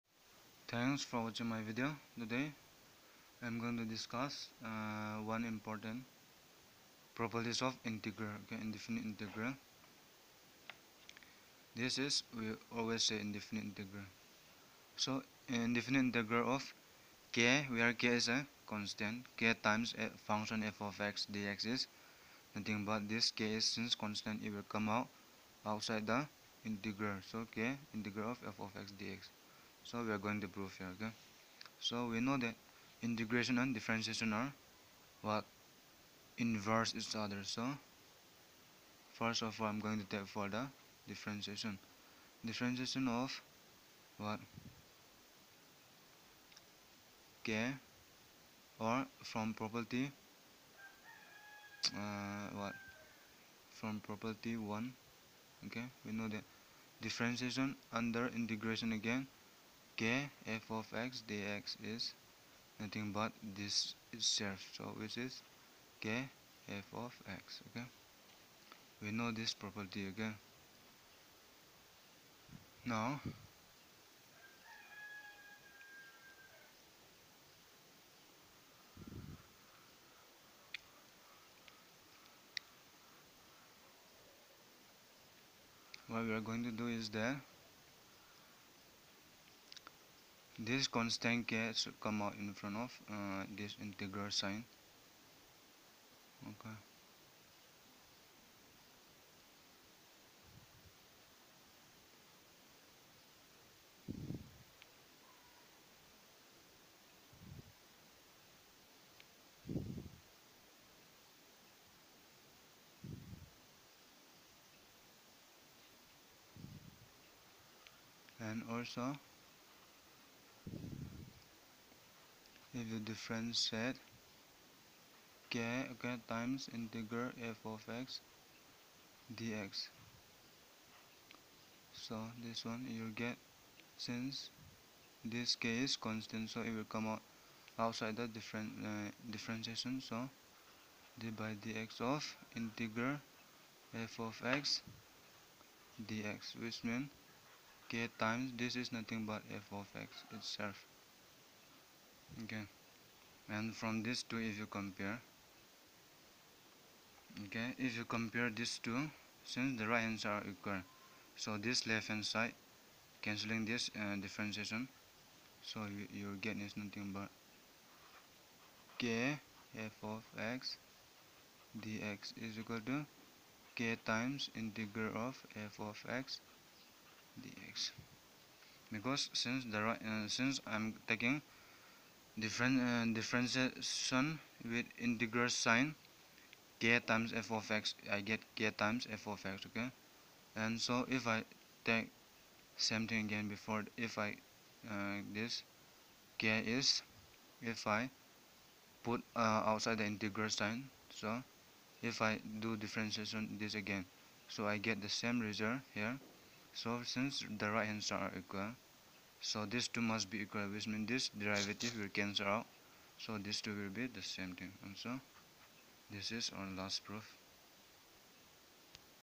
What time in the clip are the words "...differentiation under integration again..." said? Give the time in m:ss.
0:57.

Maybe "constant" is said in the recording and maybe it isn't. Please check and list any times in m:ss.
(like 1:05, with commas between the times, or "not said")
0:18, 0:23, 1:30, 2:15.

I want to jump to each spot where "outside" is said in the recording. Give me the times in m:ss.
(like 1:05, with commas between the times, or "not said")
0:25, 2:17, 3:19.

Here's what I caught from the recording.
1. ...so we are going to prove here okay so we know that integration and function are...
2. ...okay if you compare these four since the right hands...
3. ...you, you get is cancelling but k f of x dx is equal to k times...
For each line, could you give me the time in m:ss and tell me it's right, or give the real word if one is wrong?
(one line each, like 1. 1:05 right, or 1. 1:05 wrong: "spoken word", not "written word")
1. 0:29 wrong: "differentiation", not "function"
2. 2:37 wrong: "two", not "four"
3. 2:45 wrong: "nothing", not "cancelling".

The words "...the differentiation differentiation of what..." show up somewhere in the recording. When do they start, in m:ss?
0:40.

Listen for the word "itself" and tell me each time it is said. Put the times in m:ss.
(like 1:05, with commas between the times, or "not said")
1:04, 2:30.